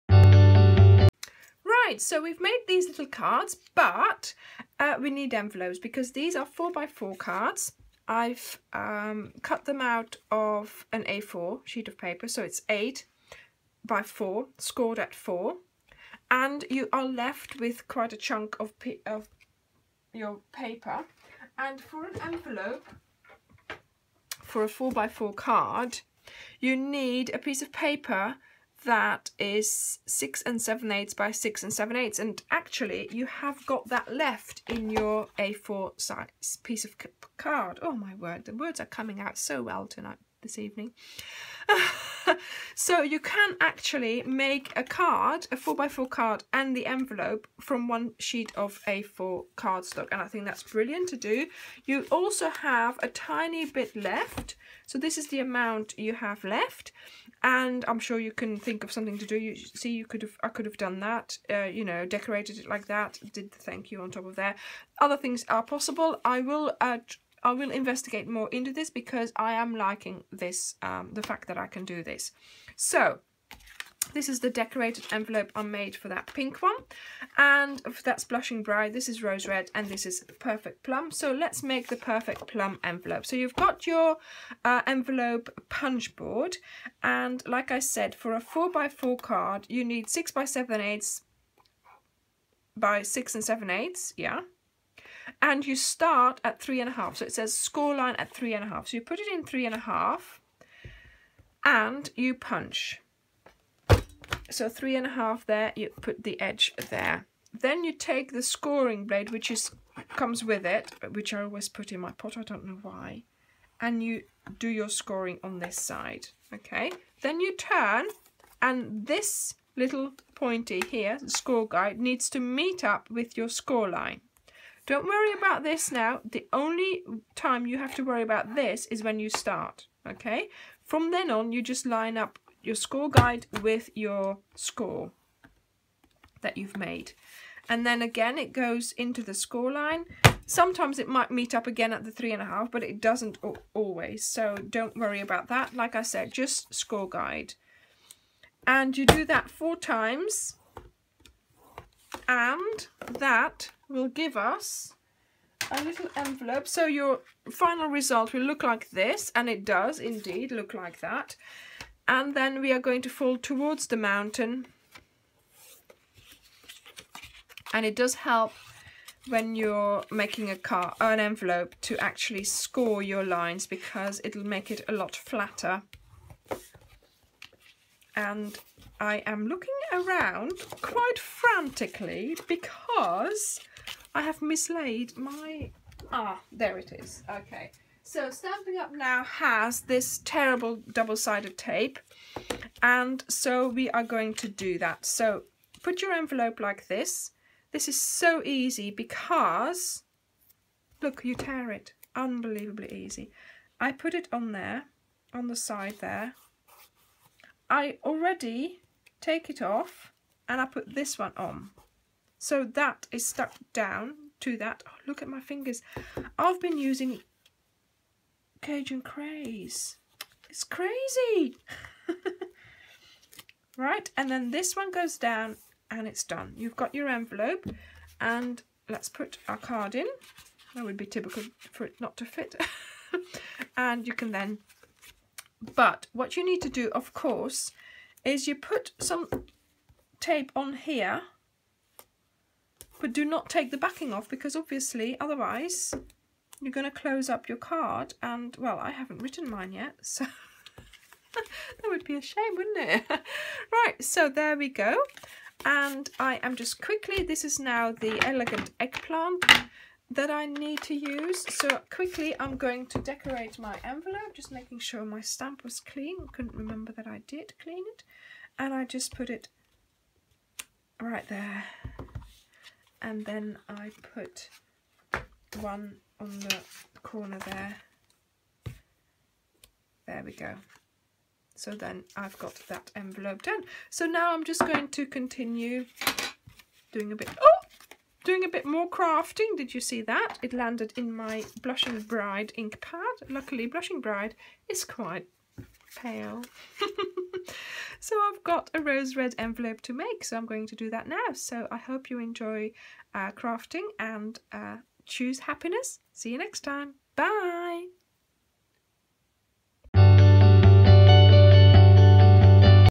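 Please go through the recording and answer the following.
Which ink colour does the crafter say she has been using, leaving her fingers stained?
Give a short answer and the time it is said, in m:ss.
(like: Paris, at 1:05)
Cajun Craze, at 3:38.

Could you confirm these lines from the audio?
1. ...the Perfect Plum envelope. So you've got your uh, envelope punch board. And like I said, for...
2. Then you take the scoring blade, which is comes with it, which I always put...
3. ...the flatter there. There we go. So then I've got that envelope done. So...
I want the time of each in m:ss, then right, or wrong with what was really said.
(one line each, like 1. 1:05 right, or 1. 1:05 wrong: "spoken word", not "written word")
1. 1:21 right
2. 1:47 right
3. 4:36 wrong: "corner", not "flatter".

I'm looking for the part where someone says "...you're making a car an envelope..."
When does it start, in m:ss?
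2:49.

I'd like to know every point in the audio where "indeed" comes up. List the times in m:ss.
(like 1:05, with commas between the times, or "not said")
2:39.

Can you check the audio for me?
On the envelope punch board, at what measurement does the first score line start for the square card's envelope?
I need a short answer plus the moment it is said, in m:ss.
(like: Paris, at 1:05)
3 1/2, at 1:36.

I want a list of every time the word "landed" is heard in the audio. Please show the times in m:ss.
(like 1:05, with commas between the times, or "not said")
4:50.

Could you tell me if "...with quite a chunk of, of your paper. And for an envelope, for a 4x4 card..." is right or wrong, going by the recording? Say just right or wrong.
right.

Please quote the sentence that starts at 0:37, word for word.
Oh my word, the words are coming out so well tonight this evening.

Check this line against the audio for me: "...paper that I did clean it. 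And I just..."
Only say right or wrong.
wrong.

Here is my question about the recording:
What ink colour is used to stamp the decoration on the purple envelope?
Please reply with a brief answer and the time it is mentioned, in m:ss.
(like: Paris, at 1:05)
Elegant Eggplant, at 4:18.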